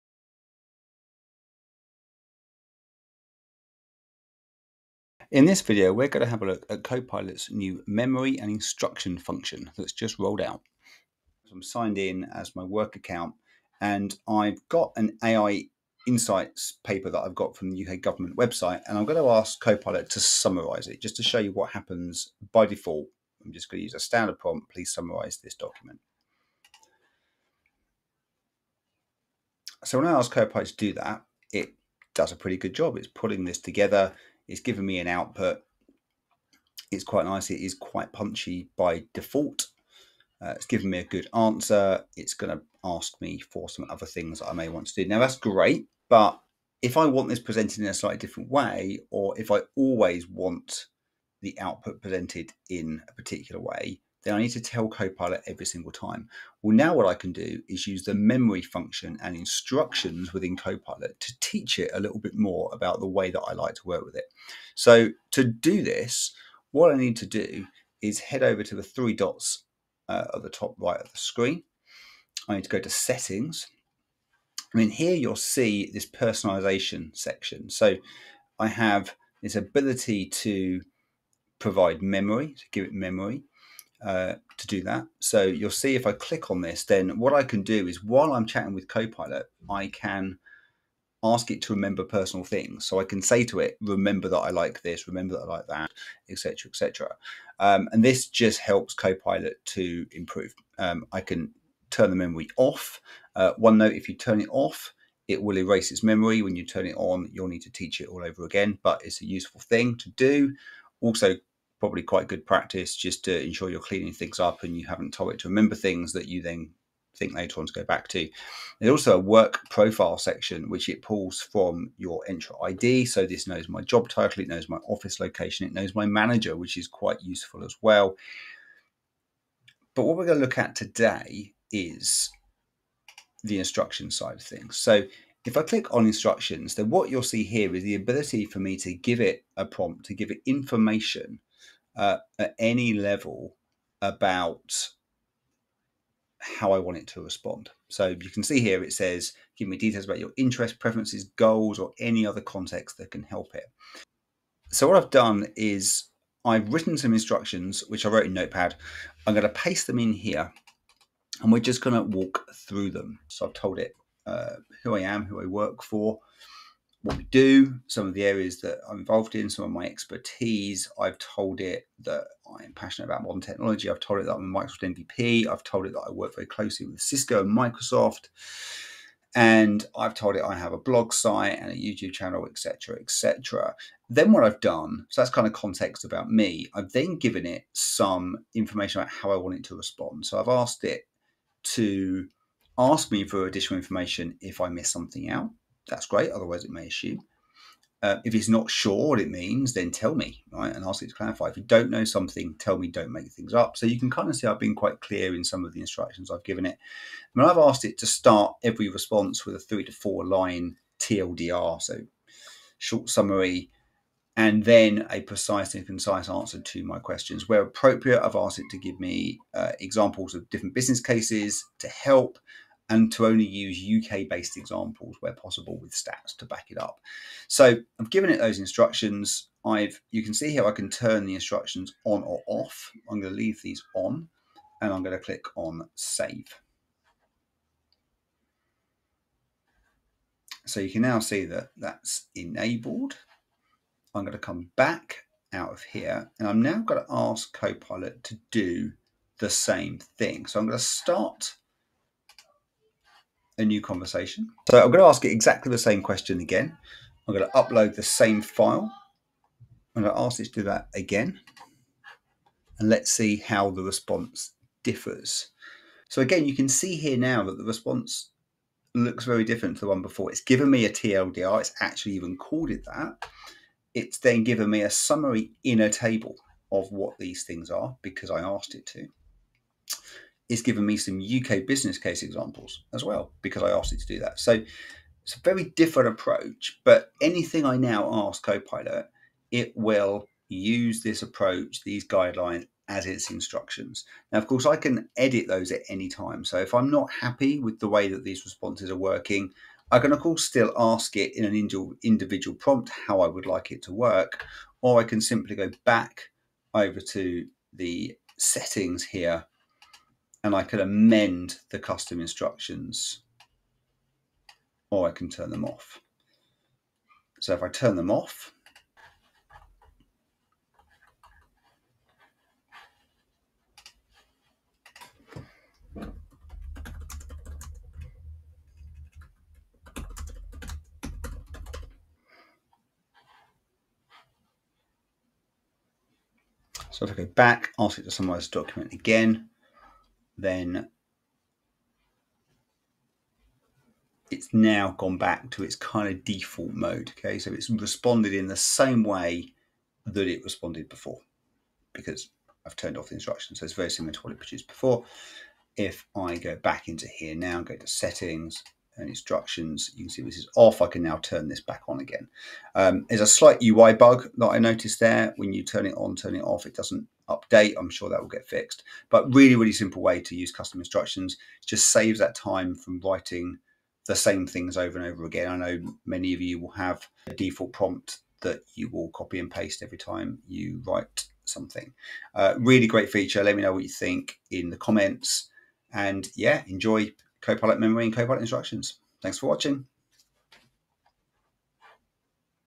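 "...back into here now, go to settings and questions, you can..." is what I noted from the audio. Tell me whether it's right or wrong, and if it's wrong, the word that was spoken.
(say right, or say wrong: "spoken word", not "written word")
wrong: "instructions", not "questions".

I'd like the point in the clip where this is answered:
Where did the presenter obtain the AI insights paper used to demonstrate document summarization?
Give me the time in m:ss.
0:17.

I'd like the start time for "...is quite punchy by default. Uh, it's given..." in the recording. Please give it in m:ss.
0:37.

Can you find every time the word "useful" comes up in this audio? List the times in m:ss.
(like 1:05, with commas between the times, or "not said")
1:49, 2:07.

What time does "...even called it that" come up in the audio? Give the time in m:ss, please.
4:32.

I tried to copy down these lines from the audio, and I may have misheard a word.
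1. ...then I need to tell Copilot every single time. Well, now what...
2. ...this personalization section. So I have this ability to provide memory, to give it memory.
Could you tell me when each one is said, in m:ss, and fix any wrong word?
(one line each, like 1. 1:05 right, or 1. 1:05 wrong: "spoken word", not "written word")
1. 0:54 right
2. 1:15 right.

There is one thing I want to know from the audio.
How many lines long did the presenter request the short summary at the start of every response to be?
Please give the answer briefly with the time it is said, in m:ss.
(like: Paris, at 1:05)
3 to 4 lines, at 3:29.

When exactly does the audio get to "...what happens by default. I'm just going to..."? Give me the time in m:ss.
0:21.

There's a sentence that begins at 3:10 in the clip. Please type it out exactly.
So I've asked it to ask me for additional information if I miss something out that's great.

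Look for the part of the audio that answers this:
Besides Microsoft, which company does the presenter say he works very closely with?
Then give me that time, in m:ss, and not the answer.
2:57.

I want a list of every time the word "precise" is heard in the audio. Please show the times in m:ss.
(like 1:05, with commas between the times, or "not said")
3:35.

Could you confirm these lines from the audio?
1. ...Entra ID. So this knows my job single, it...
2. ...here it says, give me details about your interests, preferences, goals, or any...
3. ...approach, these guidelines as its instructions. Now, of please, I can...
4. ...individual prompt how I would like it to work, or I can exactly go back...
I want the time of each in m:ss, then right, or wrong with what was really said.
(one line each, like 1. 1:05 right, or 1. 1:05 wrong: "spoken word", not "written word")
1. 2:02 wrong: "title", not "single"
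2. 2:28 right
3. 4:51 wrong: "course", not "please"
4. 5:02 wrong: "simply", not "exactly".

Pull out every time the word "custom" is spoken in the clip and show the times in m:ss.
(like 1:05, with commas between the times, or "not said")
5:11, 6:10.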